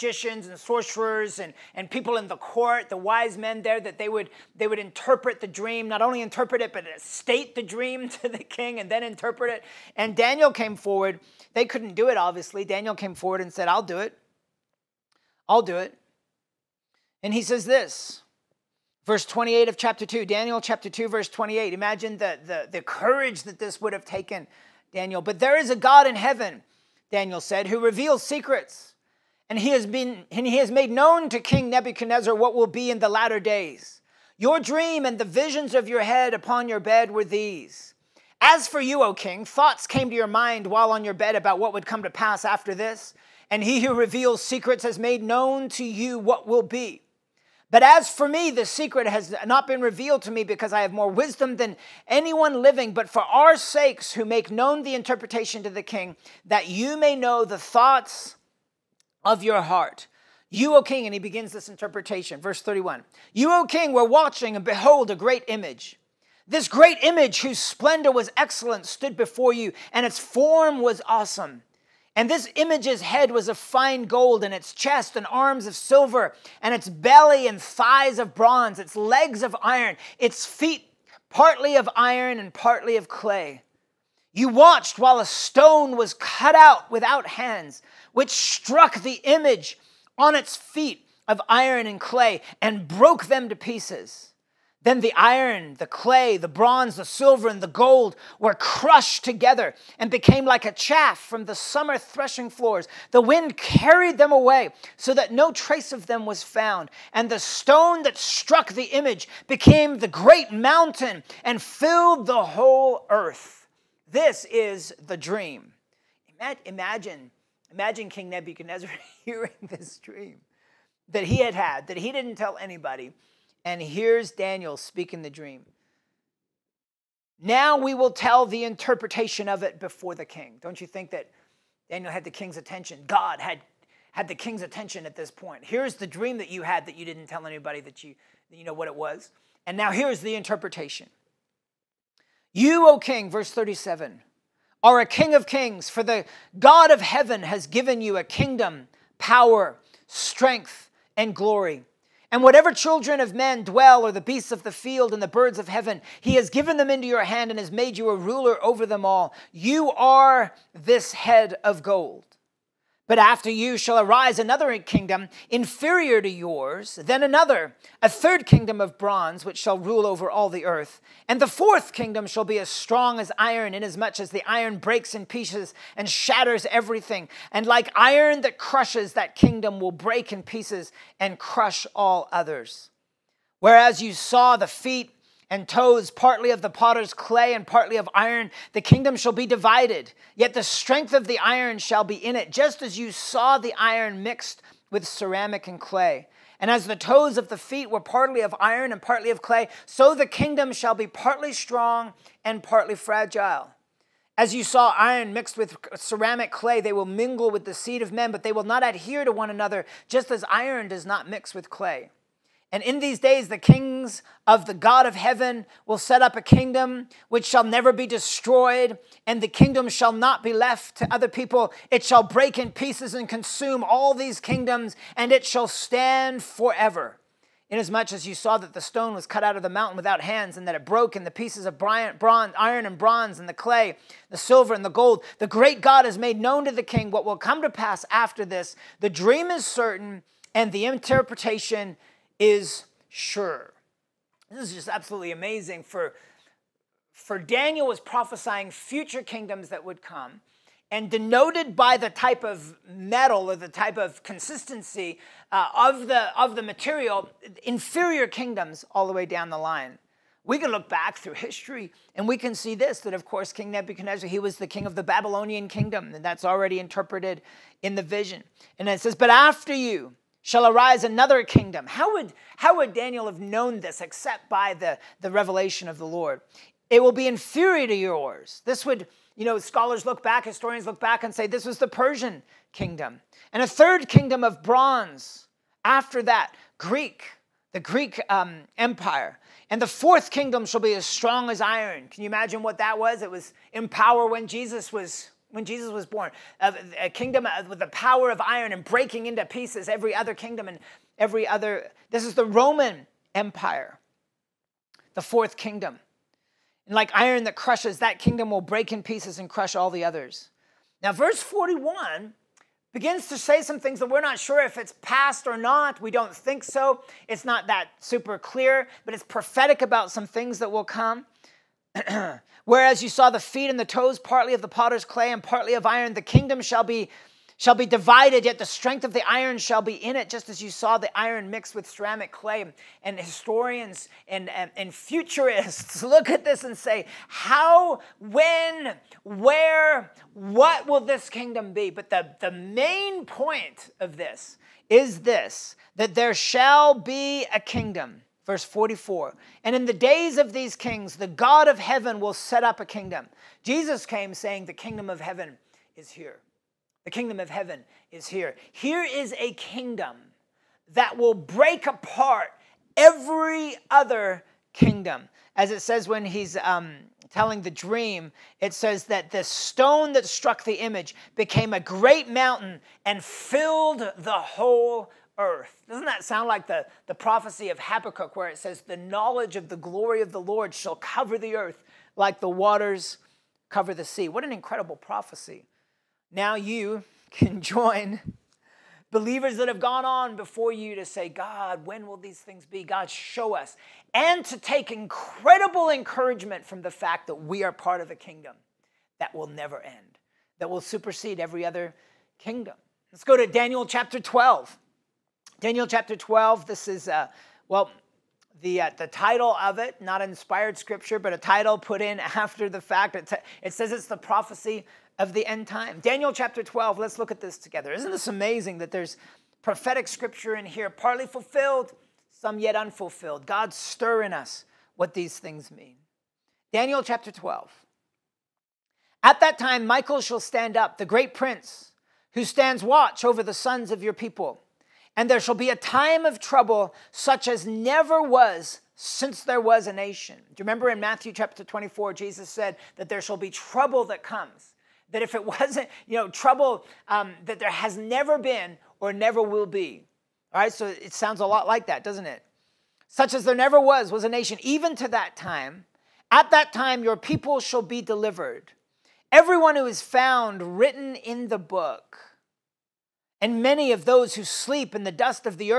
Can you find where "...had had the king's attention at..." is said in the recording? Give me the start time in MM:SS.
02:13.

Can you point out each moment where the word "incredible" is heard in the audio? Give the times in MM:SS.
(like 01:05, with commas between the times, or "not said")
06:24, 06:34.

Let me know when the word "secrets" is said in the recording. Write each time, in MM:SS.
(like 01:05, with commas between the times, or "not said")
00:28, 00:44, 00:48.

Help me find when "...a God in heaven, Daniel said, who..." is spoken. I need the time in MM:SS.
00:25.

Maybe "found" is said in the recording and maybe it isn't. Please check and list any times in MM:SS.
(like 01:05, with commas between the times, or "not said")
01:46, 07:40.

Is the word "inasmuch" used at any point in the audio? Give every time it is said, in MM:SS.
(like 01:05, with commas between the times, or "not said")
02:53, 03:47.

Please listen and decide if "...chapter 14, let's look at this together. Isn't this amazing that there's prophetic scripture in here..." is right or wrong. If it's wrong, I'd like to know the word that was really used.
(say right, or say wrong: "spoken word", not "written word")
wrong: "12", not "14".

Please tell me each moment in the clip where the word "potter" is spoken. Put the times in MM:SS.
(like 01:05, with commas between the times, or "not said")
03:06, 05:24.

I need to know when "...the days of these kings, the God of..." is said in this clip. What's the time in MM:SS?
05:49.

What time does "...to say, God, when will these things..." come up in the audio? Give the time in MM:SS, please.
06:30.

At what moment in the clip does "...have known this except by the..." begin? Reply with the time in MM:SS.
04:33.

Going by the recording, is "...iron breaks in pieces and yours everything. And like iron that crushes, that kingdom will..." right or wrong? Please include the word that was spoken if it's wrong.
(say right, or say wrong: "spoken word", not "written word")
wrong: "shatters", not "yours".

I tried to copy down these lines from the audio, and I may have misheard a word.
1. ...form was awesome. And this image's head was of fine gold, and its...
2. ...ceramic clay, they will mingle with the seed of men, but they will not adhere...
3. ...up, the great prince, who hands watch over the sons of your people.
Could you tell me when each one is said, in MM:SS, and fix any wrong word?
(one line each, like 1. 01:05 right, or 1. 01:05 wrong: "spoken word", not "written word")
1. 01:10 right
2. 03:25 right
3. 07:10 wrong: "stands", not "hands".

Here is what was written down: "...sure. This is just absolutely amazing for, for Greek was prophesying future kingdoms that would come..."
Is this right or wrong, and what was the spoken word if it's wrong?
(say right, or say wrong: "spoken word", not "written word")
wrong: "Daniel", not "Greek".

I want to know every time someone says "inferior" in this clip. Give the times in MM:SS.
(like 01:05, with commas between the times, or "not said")
02:45, 04:17, 04:37.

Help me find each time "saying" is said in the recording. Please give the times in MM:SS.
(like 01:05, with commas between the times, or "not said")
05:54.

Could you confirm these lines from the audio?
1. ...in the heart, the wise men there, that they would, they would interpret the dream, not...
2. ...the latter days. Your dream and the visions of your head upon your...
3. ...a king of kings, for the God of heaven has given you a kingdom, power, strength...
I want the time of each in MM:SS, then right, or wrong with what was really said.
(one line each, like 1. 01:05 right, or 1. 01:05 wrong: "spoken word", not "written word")
1. 00:02 wrong: "court", not "heart"
2. 00:33 right
3. 02:24 right.